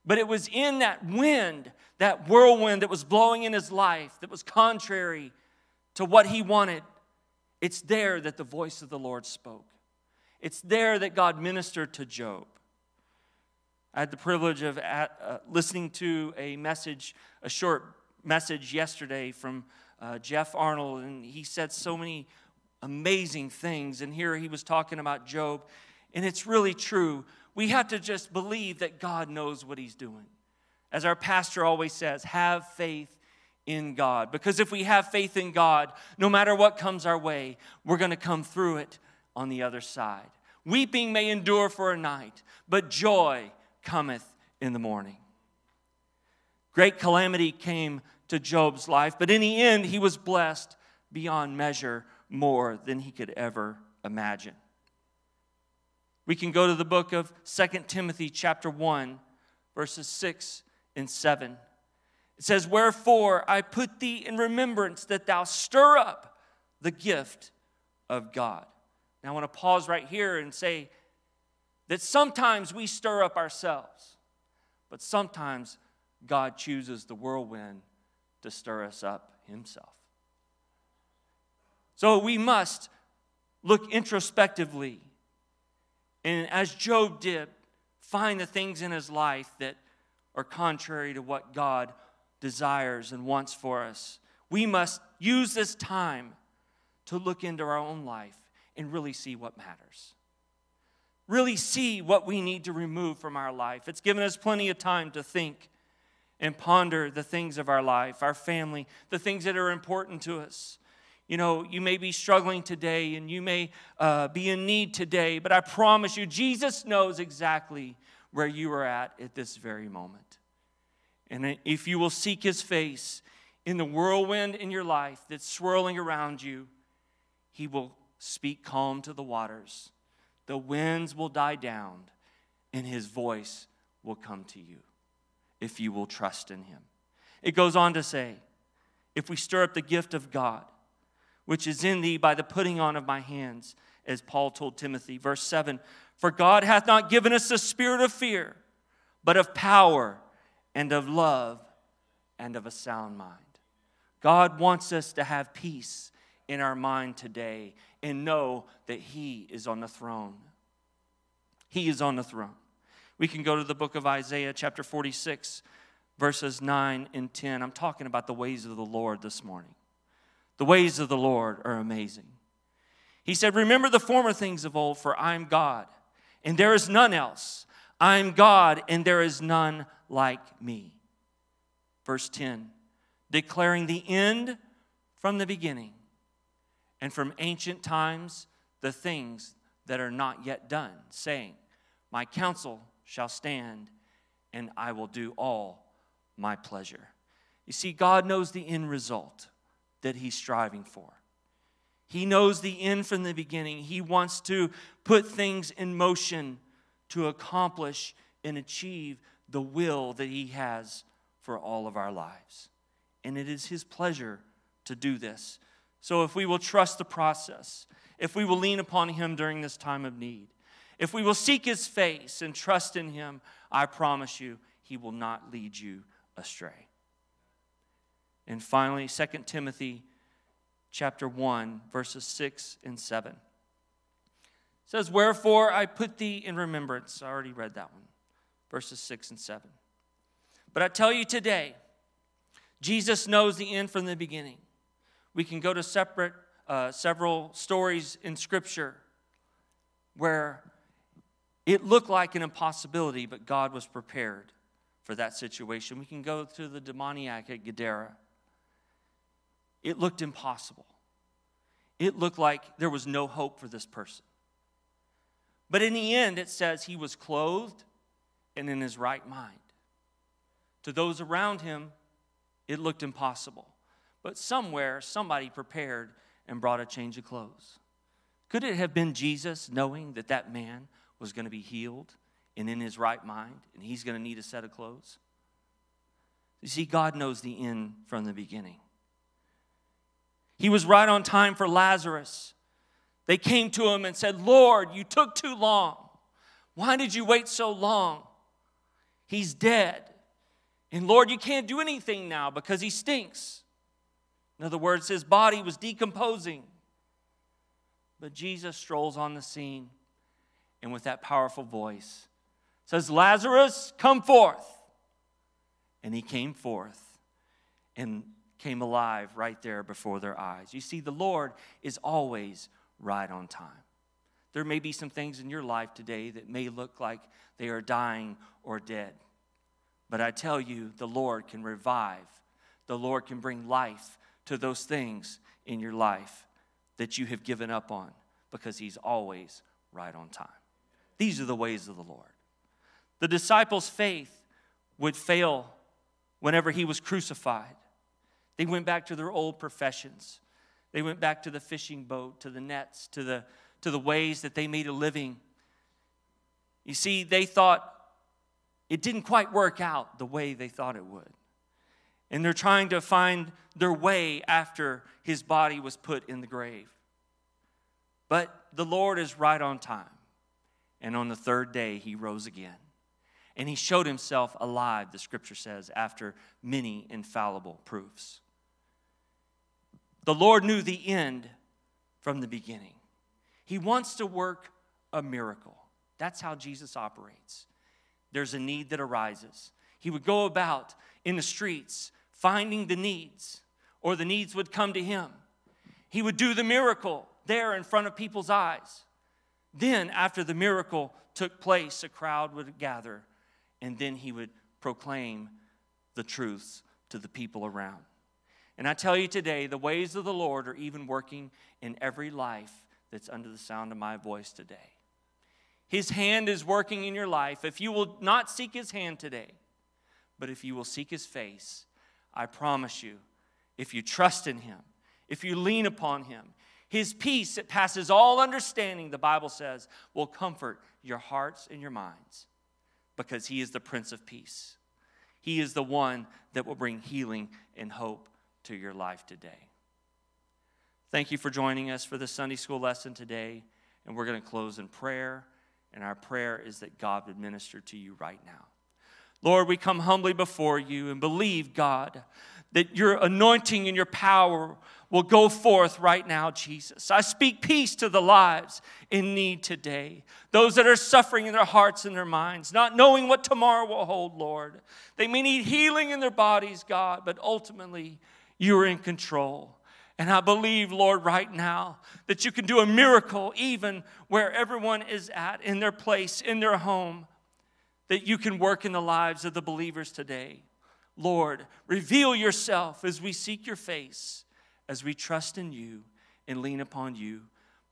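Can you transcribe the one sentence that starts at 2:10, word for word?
The winds will die down, and his voice will come to you if you will trust in him.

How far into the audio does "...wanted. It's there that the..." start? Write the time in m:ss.
0:06.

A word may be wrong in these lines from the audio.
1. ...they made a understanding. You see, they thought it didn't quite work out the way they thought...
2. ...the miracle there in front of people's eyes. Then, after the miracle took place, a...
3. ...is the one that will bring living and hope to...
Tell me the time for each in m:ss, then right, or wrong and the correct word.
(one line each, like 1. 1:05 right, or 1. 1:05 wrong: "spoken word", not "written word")
1. 5:54 wrong: "living", not "understanding"
2. 6:36 right
3. 7:15 wrong: "healing", not "living".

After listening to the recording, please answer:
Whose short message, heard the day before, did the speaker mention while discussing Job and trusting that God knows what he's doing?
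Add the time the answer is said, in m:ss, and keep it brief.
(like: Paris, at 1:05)
Jeff Arnold, at 0:20.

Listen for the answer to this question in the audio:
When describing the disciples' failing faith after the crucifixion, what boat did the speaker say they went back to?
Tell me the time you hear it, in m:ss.
5:51.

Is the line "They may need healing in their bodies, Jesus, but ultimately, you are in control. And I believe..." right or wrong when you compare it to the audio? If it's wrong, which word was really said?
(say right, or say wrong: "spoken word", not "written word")
wrong: "God", not "Jesus".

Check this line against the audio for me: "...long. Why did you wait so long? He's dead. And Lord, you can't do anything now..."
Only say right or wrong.
right.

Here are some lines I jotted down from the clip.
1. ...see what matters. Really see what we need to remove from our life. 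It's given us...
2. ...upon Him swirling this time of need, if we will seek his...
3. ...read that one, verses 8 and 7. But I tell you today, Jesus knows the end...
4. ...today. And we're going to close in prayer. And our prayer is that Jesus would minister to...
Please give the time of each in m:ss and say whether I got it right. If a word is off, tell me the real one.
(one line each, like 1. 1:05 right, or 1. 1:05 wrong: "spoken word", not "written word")
1. 1:39 right
2. 3:38 wrong: "during", not "swirling"
3. 3:57 wrong: "6", not "8"
4. 7:23 wrong: "God", not "Jesus".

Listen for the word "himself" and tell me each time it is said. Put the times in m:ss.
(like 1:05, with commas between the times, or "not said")
1:19, 6:14.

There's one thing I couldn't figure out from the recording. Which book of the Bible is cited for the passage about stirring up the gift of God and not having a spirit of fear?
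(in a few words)
Second Timothy.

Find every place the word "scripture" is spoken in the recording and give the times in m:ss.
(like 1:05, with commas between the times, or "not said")
4:08, 6:15.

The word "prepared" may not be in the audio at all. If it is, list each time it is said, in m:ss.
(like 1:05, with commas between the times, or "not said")
4:13, 4:35.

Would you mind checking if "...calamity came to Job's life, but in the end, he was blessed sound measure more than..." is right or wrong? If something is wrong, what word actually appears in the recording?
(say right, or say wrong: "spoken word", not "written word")
wrong: "beyond", not "sound".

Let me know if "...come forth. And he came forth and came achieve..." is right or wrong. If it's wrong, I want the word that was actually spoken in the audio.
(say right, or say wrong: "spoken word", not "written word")
wrong: "alive", not "achieve".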